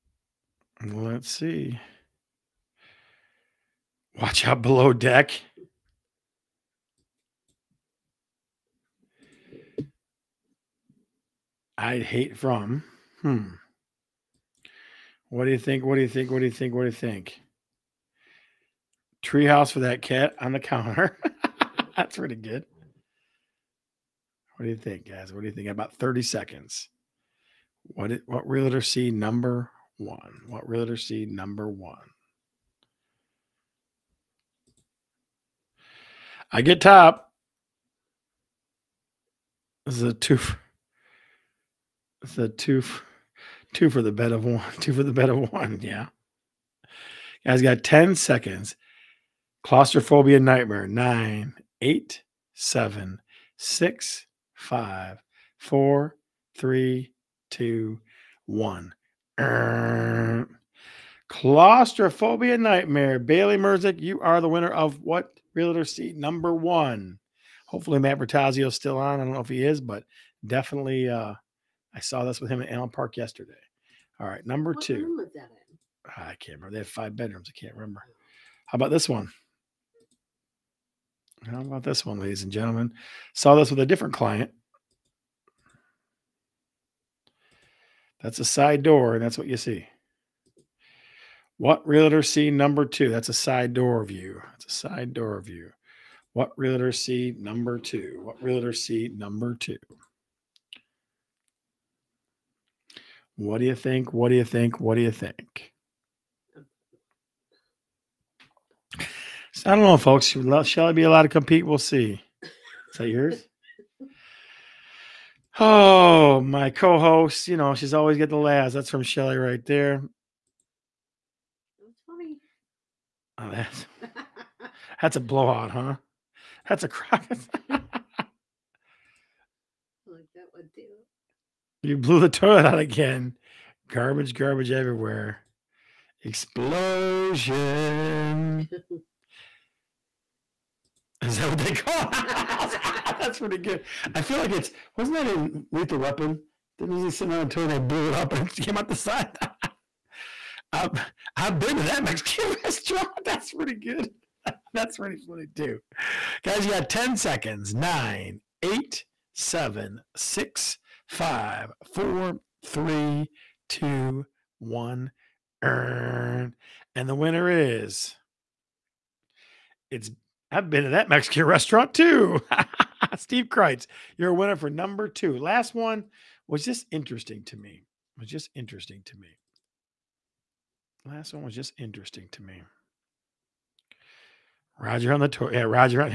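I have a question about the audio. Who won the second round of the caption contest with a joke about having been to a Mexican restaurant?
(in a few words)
Steve Kreitz.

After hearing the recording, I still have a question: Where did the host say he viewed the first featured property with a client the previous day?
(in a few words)
Allen Park.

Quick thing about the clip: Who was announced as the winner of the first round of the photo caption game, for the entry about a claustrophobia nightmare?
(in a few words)
Bailey Merzik.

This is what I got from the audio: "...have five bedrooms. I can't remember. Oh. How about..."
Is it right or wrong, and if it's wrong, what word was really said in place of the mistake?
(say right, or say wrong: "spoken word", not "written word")
right.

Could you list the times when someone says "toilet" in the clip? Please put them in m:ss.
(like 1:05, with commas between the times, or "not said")
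2:12, 2:27, 3:05.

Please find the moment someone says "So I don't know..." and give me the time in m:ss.
1:49.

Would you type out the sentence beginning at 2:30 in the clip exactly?
I've I've been to that Mexican restaurant.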